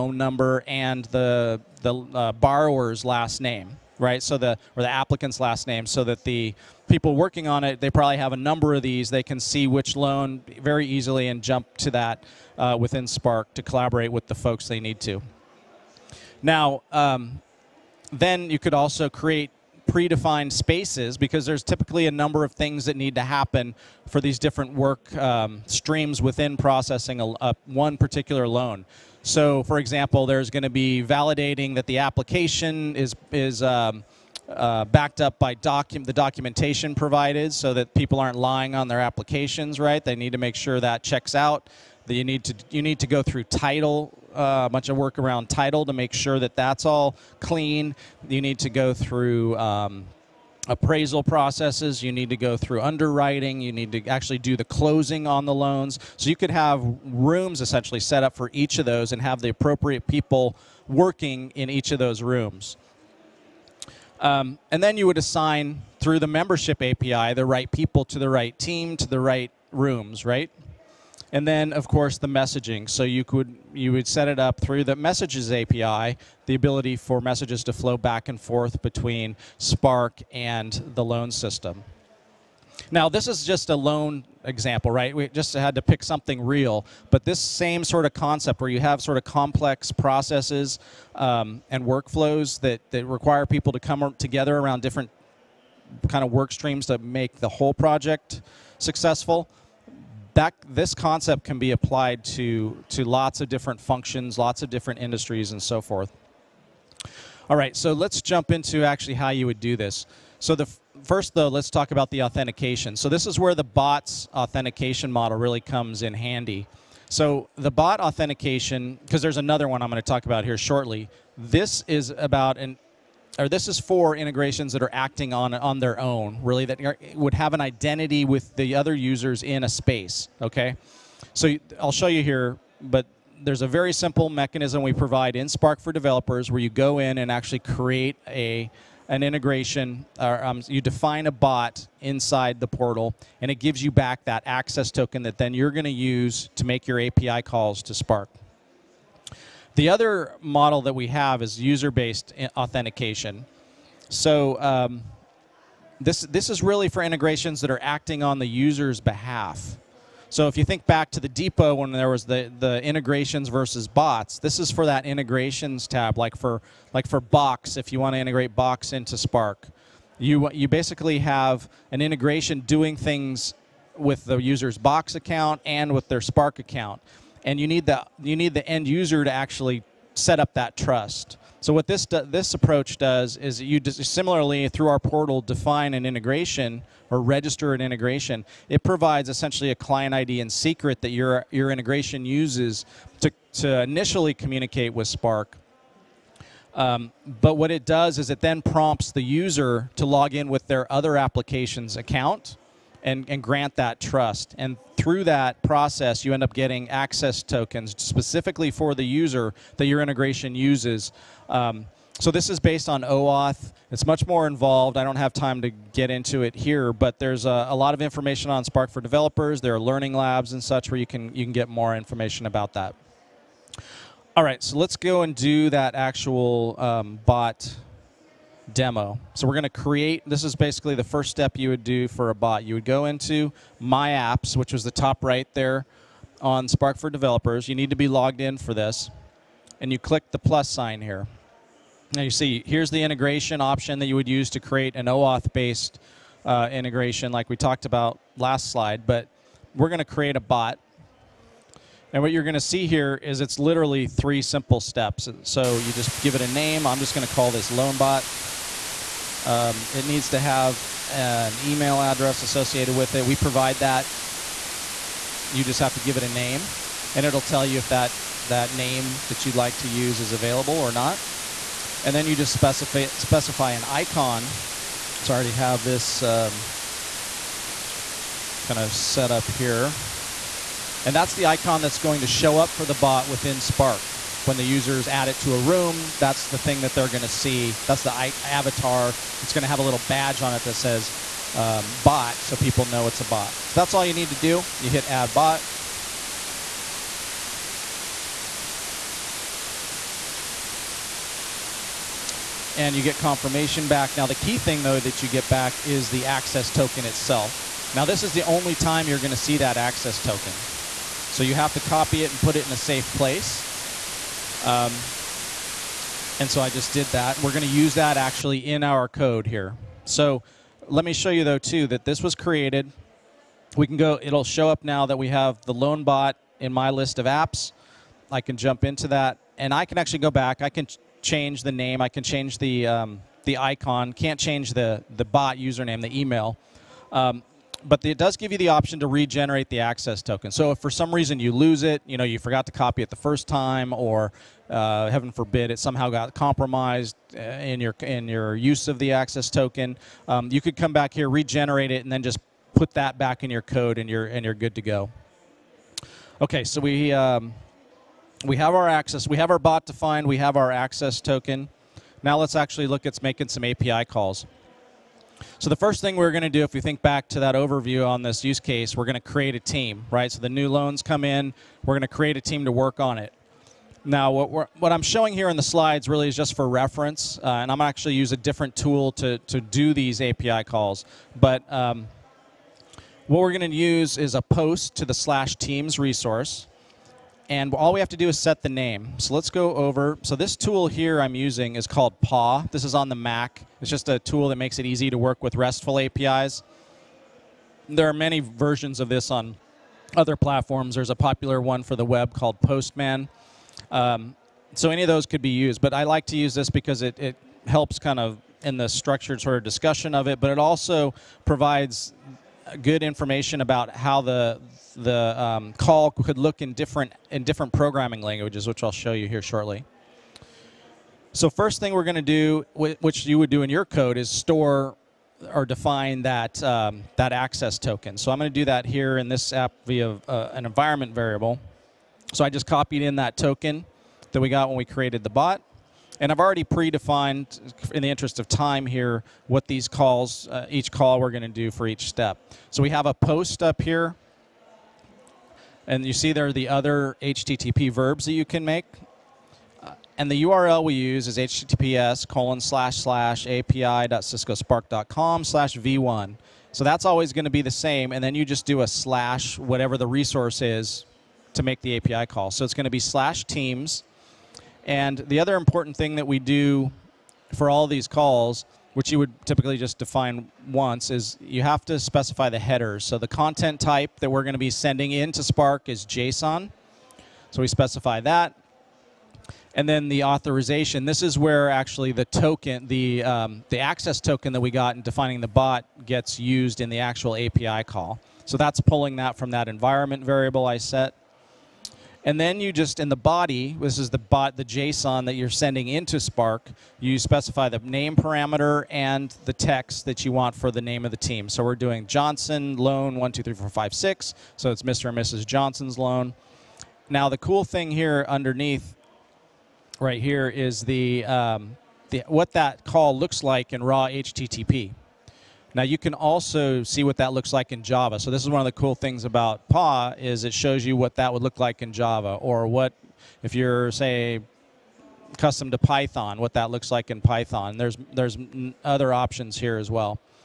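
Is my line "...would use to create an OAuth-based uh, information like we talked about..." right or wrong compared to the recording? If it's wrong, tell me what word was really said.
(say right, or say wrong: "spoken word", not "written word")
wrong: "integration", not "information".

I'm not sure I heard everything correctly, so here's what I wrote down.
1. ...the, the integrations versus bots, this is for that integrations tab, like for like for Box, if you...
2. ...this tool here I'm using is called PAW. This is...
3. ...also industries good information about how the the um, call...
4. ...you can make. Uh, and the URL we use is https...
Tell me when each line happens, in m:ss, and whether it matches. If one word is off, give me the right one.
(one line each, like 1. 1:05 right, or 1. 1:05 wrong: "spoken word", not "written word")
1. 2:42 right
2. 6:30 right
3. 6:50 wrong: "provides", not "industries"
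4. 7:28 right.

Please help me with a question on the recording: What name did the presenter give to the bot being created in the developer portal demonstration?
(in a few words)
LoanBot.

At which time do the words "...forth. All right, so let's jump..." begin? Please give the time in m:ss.
1:45.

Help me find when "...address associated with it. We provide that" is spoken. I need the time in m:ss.
4:22.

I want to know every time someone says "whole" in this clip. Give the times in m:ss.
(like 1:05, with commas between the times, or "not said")
1:37.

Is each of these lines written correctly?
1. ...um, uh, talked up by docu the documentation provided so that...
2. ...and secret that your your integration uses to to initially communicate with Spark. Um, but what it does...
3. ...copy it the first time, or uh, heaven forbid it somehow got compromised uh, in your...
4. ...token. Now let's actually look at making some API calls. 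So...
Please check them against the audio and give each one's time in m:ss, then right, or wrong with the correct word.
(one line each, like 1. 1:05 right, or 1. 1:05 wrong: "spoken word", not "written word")
1. 0:33 wrong: "backed", not "talked"
2. 3:10 right
3. 5:42 right
4. 6:01 right.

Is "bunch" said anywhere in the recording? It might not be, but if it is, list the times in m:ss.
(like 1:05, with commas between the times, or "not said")
0:44.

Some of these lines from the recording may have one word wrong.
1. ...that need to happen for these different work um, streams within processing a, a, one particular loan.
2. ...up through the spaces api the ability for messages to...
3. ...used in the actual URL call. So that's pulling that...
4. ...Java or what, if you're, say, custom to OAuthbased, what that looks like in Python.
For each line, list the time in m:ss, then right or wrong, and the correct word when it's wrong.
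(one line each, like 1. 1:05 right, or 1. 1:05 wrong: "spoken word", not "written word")
1. 0:22 right
2. 1:14 wrong: "messages", not "spaces"
3. 8:06 wrong: "API", not "URL"
4. 8:41 wrong: "Python", not "OAuthbased".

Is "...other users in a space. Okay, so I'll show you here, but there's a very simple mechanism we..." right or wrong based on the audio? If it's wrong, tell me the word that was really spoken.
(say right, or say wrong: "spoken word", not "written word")
right.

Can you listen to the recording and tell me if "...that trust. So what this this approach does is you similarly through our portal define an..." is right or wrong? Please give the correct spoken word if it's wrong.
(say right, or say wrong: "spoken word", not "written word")
right.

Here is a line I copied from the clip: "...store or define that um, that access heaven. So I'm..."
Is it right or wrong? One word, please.
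wrong.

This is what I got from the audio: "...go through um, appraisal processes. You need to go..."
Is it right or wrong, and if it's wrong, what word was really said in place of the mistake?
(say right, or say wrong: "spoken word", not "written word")
right.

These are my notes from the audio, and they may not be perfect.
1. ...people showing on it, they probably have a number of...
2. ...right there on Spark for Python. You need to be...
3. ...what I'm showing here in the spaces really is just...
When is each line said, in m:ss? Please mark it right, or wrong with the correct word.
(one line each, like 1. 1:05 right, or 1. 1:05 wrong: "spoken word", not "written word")
1. 0:06 wrong: "working", not "showing"
2. 3:55 wrong: "Developers", not "Python"
3. 6:14 wrong: "slides", not "spaces".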